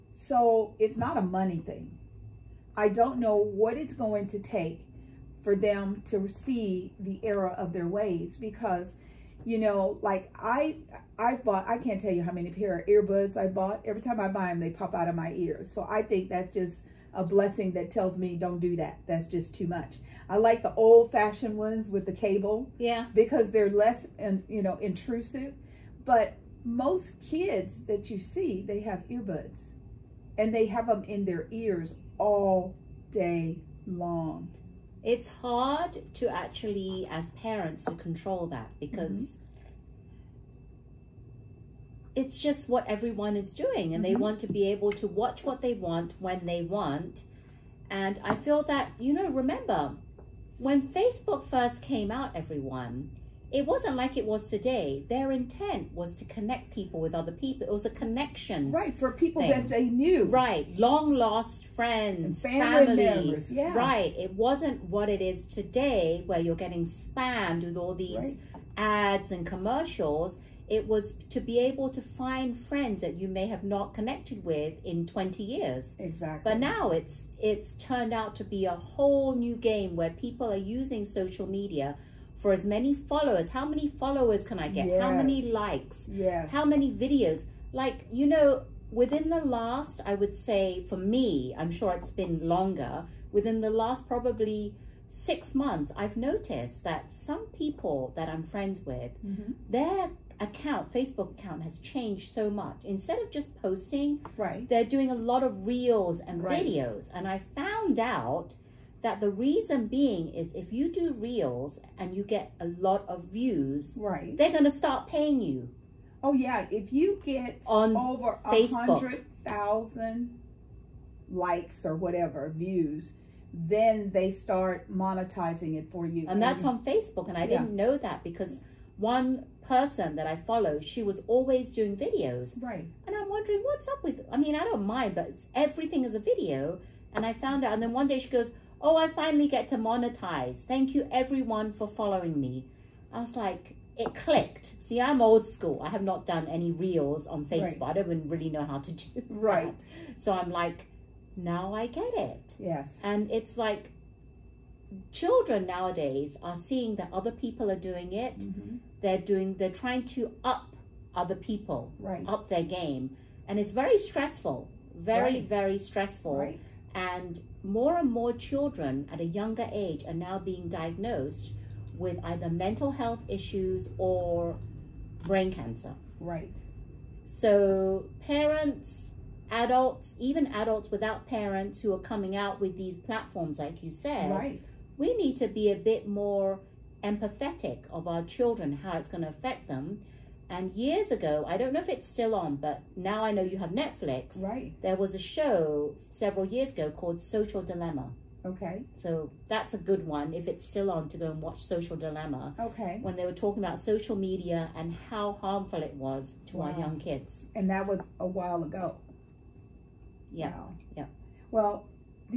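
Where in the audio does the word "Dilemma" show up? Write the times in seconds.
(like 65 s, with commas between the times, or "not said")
197 s, 201 s.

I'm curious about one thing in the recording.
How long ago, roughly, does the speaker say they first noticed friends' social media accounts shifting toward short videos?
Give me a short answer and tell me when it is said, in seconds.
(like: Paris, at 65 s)
6 months, at 95 s.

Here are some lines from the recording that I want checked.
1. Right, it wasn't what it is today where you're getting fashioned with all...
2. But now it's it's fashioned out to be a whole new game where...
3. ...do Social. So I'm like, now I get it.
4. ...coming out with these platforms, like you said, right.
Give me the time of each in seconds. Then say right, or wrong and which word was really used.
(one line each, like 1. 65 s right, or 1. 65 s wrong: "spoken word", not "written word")
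1. 63 s wrong: "spammed", not "fashioned"
2. 76 s wrong: "turned", not "fashioned"
3. 148 s wrong: "Right", not "Social"
4. 181 s right.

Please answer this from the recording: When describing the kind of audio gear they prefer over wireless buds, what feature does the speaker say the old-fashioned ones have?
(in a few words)
The cable.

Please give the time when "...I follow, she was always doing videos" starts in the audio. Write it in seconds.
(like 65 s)
130 s.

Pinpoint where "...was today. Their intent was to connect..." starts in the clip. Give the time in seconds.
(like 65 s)
54 s.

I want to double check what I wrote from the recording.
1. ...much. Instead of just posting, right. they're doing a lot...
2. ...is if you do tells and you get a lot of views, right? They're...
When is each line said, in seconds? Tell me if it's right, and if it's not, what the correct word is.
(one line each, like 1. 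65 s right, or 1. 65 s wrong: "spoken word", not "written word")
1. 102 s right
2. 110 s wrong: "reels", not "tells".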